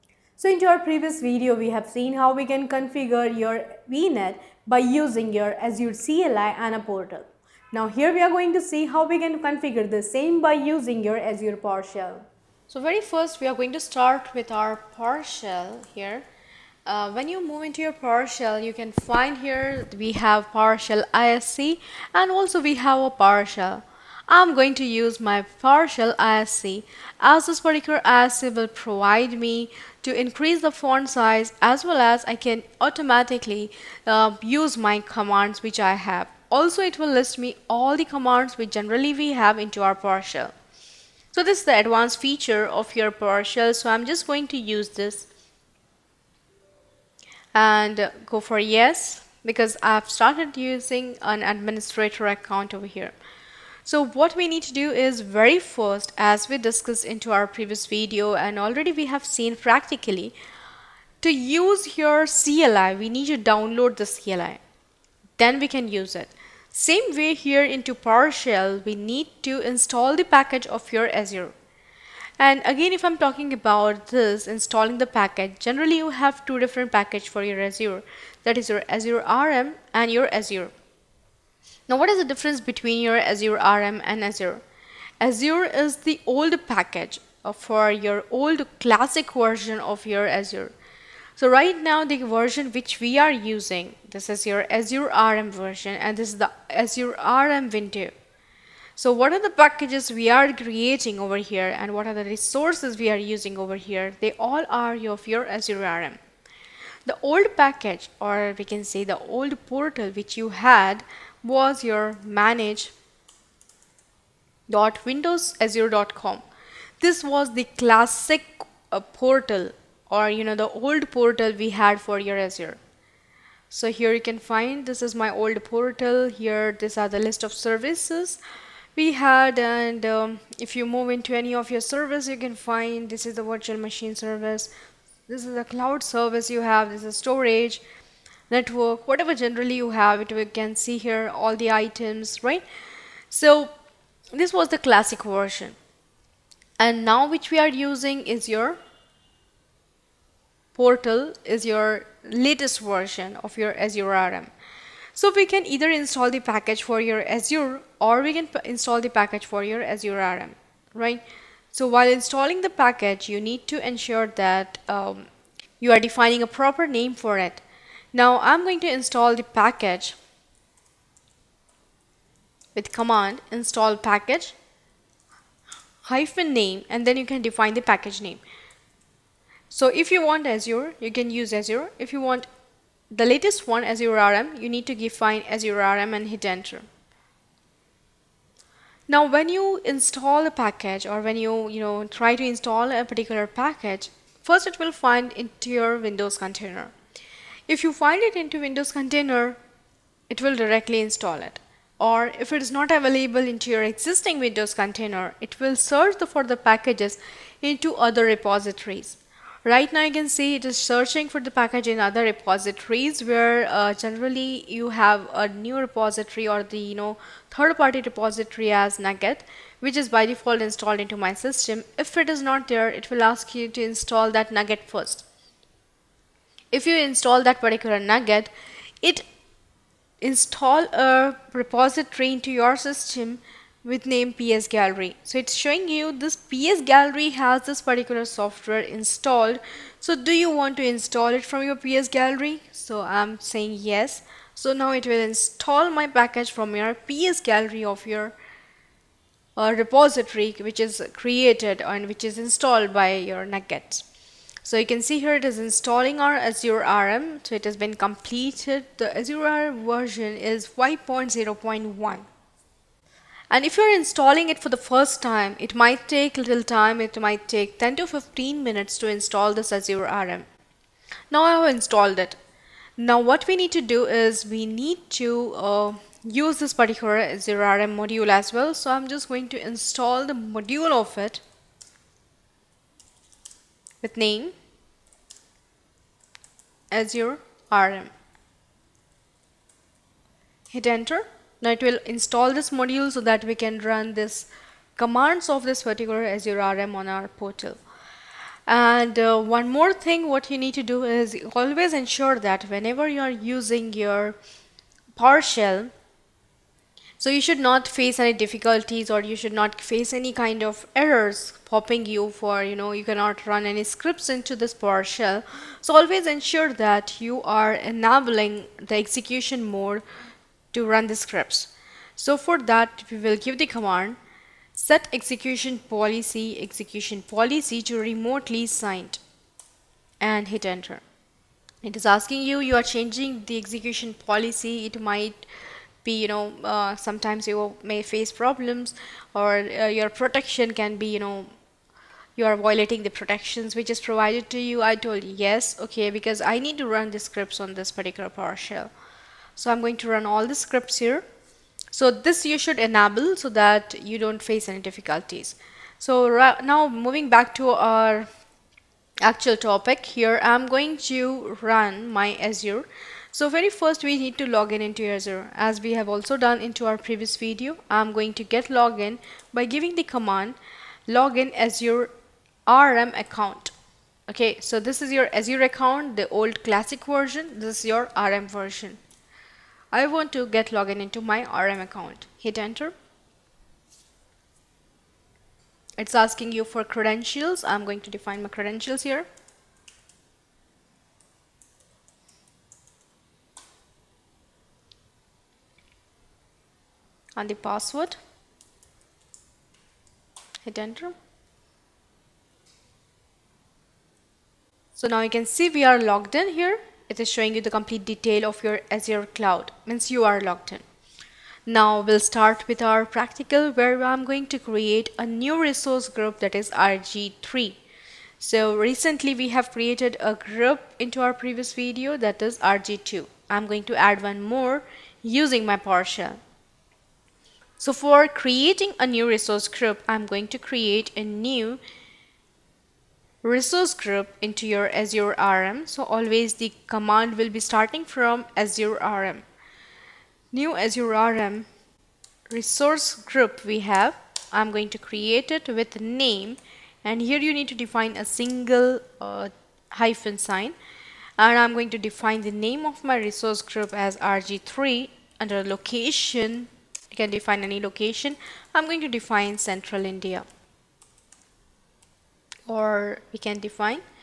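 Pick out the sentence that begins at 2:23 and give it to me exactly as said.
So this was the classic version.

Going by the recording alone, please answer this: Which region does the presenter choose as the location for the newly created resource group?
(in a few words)
Central India.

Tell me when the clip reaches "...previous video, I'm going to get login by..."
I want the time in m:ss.
6:06.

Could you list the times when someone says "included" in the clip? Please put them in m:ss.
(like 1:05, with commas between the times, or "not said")
not said.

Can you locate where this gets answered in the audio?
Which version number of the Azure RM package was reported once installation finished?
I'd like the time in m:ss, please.
4:20.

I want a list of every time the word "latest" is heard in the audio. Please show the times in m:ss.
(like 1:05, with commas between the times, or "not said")
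2:32, 3:03.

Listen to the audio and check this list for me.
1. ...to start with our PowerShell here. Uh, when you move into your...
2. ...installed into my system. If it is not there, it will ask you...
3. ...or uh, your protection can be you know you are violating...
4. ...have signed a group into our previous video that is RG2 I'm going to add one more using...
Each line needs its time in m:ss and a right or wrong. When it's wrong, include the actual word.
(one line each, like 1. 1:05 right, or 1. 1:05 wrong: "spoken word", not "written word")
1. 0:13 right
2. 3:40 right
3. 5:39 right
4. 6:59 wrong: "created", not "signed".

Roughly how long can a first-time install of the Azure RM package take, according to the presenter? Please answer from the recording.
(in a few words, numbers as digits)
10 to 15 minutes.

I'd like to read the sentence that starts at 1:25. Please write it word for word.
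Azure is the old package for your old classic version of your Azure.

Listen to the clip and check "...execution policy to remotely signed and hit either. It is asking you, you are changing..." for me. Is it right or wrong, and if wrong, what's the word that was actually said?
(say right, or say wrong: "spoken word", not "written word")
wrong: "enter", not "either".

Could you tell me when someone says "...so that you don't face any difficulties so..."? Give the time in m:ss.
5:53.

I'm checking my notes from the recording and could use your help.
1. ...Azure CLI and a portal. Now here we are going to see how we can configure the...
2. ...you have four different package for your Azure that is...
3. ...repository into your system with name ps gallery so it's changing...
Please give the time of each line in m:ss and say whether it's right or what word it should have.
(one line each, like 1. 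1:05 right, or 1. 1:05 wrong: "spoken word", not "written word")
1. 0:05 right
2. 1:15 wrong: "two", not "four"
3. 3:51 wrong: "showing", not "changing".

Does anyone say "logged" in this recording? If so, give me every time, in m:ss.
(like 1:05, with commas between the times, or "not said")
6:46, 6:50.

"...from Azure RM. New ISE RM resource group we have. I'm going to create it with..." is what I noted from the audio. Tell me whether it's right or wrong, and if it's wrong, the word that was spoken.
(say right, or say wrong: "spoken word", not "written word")
wrong: "Azure", not "ISE".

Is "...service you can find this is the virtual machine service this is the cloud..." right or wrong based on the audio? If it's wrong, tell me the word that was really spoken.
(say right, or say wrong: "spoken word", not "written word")
right.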